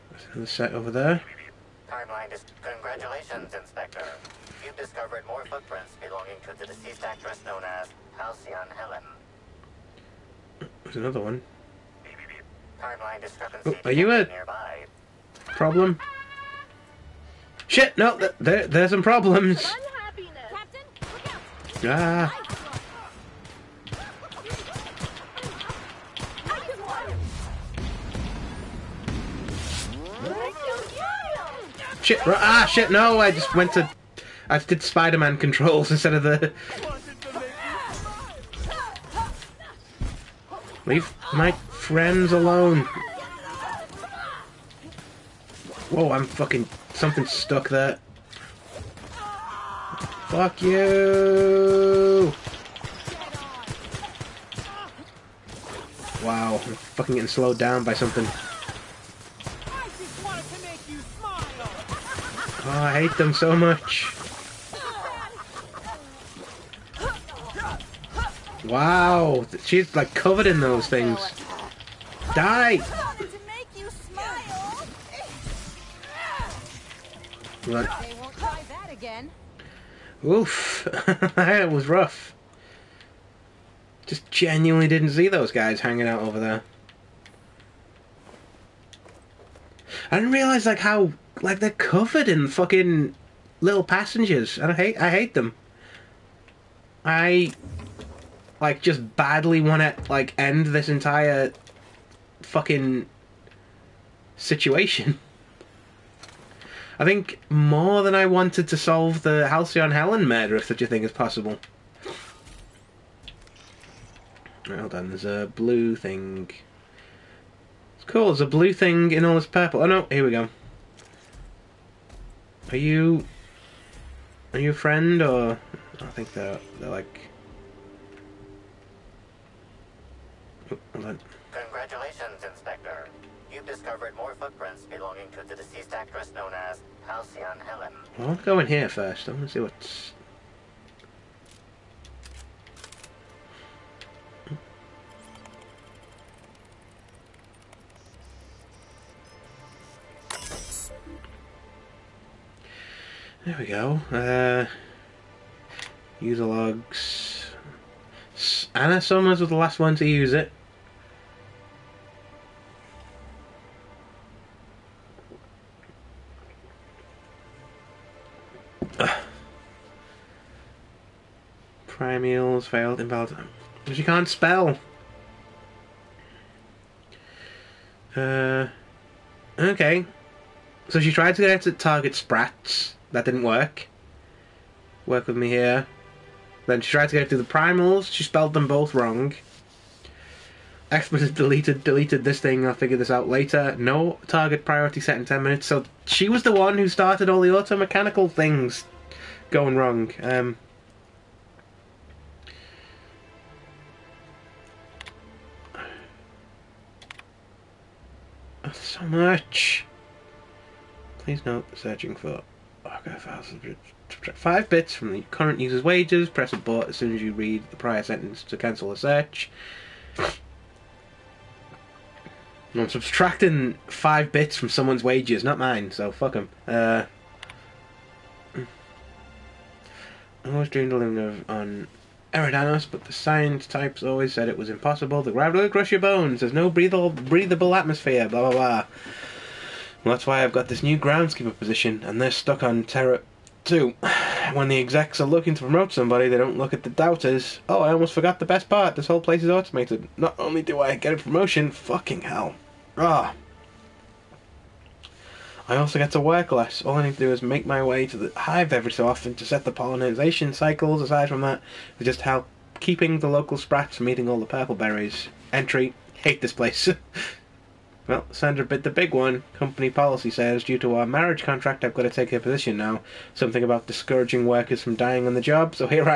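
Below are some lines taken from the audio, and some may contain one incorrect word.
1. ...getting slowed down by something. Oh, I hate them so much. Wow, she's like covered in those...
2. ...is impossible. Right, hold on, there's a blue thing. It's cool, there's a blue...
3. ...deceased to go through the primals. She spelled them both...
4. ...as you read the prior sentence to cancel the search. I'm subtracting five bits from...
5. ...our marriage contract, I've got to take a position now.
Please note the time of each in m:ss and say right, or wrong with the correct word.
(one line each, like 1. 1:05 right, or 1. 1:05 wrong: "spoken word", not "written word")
1. 0:57 right
2. 1:51 wrong: "possible", not "impossible"
3. 3:06 wrong: "tried", not "deceased"
4. 3:37 right
5. 4:30 right.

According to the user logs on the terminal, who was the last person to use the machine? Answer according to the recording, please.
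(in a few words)
Anna Summers.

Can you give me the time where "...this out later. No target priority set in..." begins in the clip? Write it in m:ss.
3:12.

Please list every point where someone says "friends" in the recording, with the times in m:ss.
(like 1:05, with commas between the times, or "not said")
0:41, 2:04.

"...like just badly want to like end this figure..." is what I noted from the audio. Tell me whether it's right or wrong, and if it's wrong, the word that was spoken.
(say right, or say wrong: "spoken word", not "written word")
wrong: "entire", not "figure".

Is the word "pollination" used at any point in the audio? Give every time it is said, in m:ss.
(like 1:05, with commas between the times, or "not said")
4:19.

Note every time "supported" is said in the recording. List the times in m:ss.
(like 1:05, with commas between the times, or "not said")
not said.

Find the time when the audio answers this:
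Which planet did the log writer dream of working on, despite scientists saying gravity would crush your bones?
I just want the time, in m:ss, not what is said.
3:52.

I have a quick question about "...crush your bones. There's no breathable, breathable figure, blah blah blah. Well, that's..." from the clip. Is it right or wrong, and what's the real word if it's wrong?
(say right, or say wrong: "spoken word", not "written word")
wrong: "atmosphere", not "figure".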